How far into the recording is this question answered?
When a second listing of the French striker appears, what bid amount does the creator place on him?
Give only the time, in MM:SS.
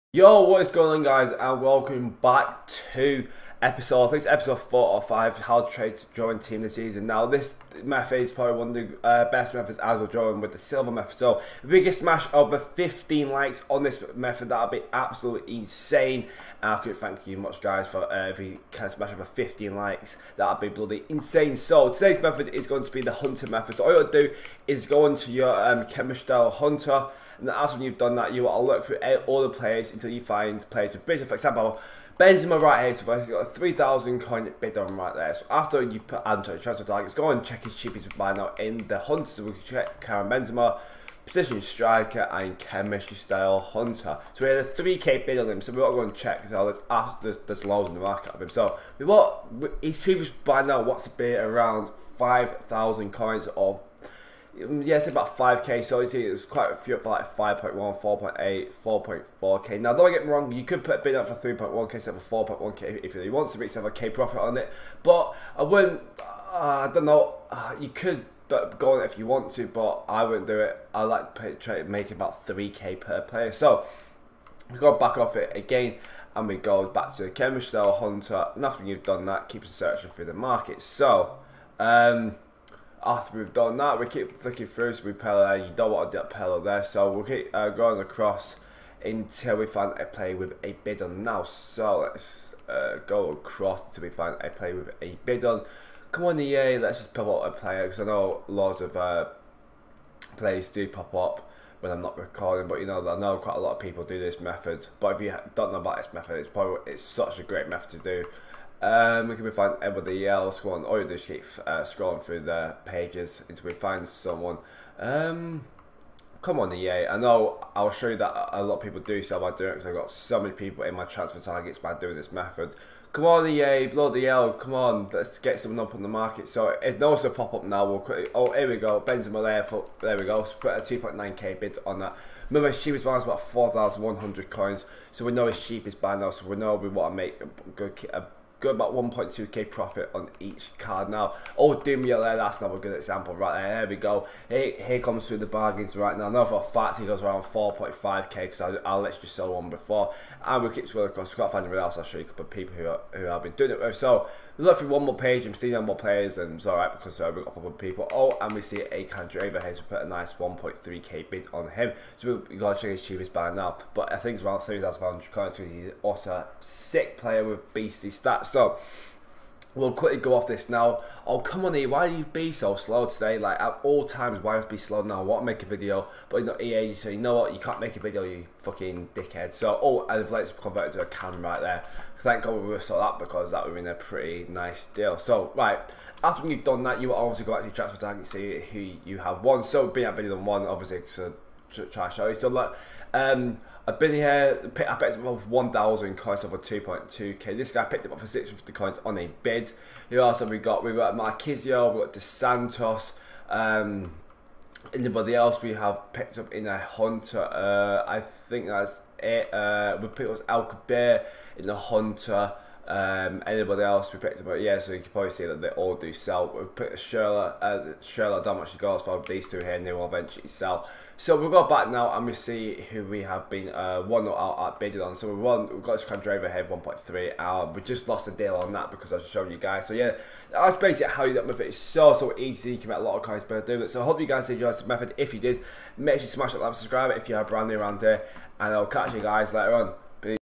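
02:10.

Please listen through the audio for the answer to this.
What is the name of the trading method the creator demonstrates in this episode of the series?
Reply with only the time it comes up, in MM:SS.
00:22.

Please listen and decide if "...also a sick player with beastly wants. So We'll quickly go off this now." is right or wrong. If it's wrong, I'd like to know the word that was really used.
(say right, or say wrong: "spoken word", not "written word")
wrong: "stats", not "wants".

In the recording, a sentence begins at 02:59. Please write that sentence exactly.
So, oh, I've let's convert it to a cam right there.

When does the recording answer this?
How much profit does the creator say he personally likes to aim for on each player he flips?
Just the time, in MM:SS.
01:12.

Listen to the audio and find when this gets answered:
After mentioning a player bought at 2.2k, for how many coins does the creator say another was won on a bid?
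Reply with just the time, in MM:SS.
03:18.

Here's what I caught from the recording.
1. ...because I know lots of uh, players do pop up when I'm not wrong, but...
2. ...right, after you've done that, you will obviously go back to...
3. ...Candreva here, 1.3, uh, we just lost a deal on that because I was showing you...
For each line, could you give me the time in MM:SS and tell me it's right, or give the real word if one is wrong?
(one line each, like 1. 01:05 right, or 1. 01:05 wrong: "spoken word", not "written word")
1. 01:37 wrong: "recording", not "wrong"
2. 03:05 right
3. 03:46 right.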